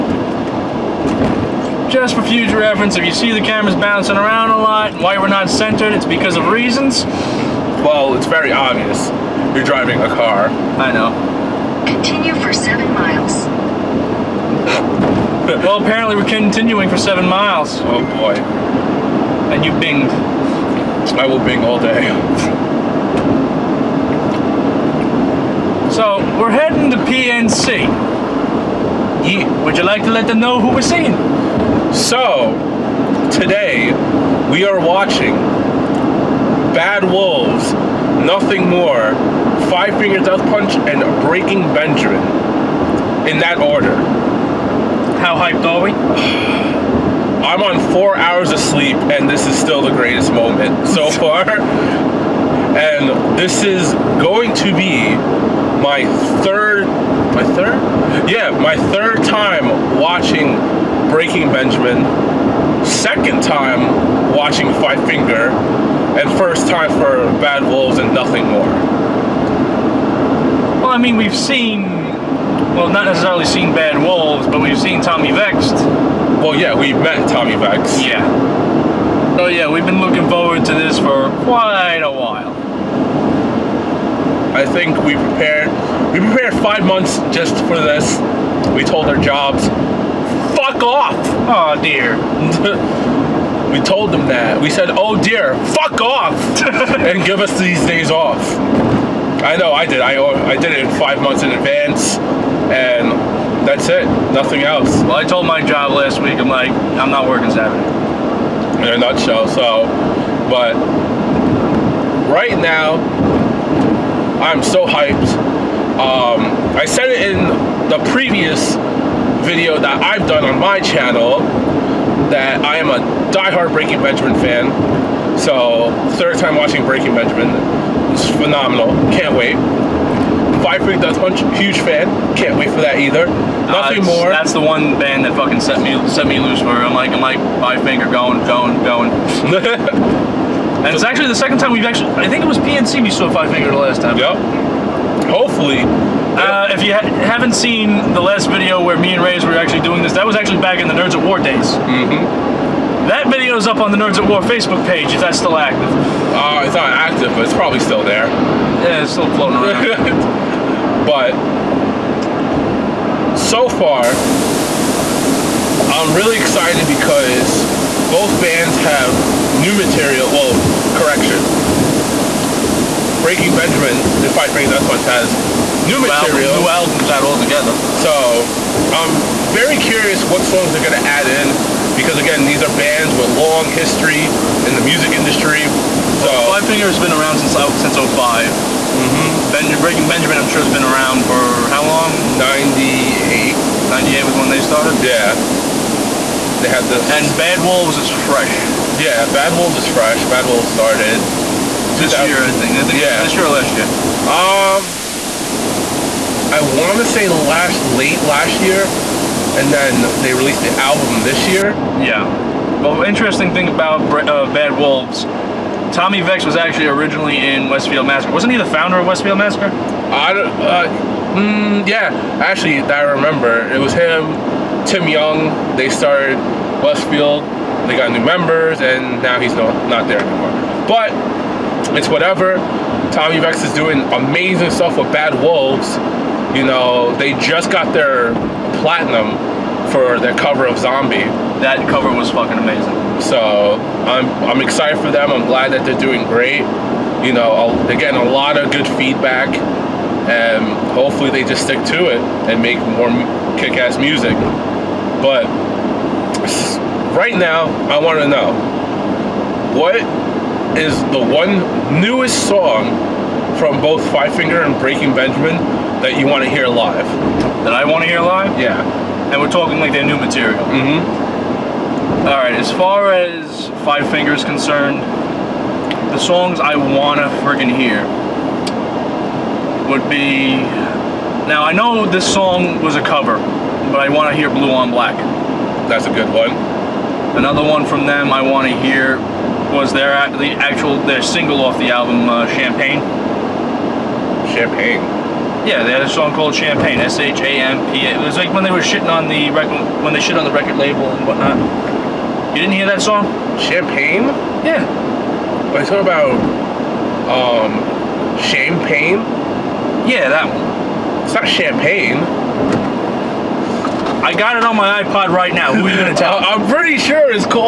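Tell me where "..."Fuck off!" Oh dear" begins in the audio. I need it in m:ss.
1:30.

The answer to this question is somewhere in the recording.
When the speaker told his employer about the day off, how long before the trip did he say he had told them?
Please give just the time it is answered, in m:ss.
1:45.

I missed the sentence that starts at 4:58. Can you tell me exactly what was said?
It was like when they were shitting on the record, when they shit on the record label and whatnot.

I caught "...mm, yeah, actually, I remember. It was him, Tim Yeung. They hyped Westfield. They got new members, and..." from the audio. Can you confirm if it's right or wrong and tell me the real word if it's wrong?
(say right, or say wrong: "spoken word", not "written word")
wrong: "started", not "hyped".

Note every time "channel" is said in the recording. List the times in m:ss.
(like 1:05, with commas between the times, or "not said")
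2:00.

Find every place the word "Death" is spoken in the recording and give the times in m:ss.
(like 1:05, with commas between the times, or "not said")
0:40, 2:11, 2:54.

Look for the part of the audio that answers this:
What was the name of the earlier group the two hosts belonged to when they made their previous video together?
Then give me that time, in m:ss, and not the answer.
2:30.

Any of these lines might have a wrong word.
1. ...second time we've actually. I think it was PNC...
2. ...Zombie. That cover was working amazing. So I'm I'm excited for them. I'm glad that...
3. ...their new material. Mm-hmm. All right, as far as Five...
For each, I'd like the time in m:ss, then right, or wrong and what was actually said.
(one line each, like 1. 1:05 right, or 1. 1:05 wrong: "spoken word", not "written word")
1. 2:21 right
2. 4:00 wrong: "fucking", not "working"
3. 4:29 right.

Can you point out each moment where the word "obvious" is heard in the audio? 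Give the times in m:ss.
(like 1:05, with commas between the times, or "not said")
0:08.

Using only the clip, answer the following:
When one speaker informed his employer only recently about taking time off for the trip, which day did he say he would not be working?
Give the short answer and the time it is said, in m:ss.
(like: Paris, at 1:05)
Saturday, at 1:47.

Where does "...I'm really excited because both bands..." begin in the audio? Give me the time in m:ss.
2:45.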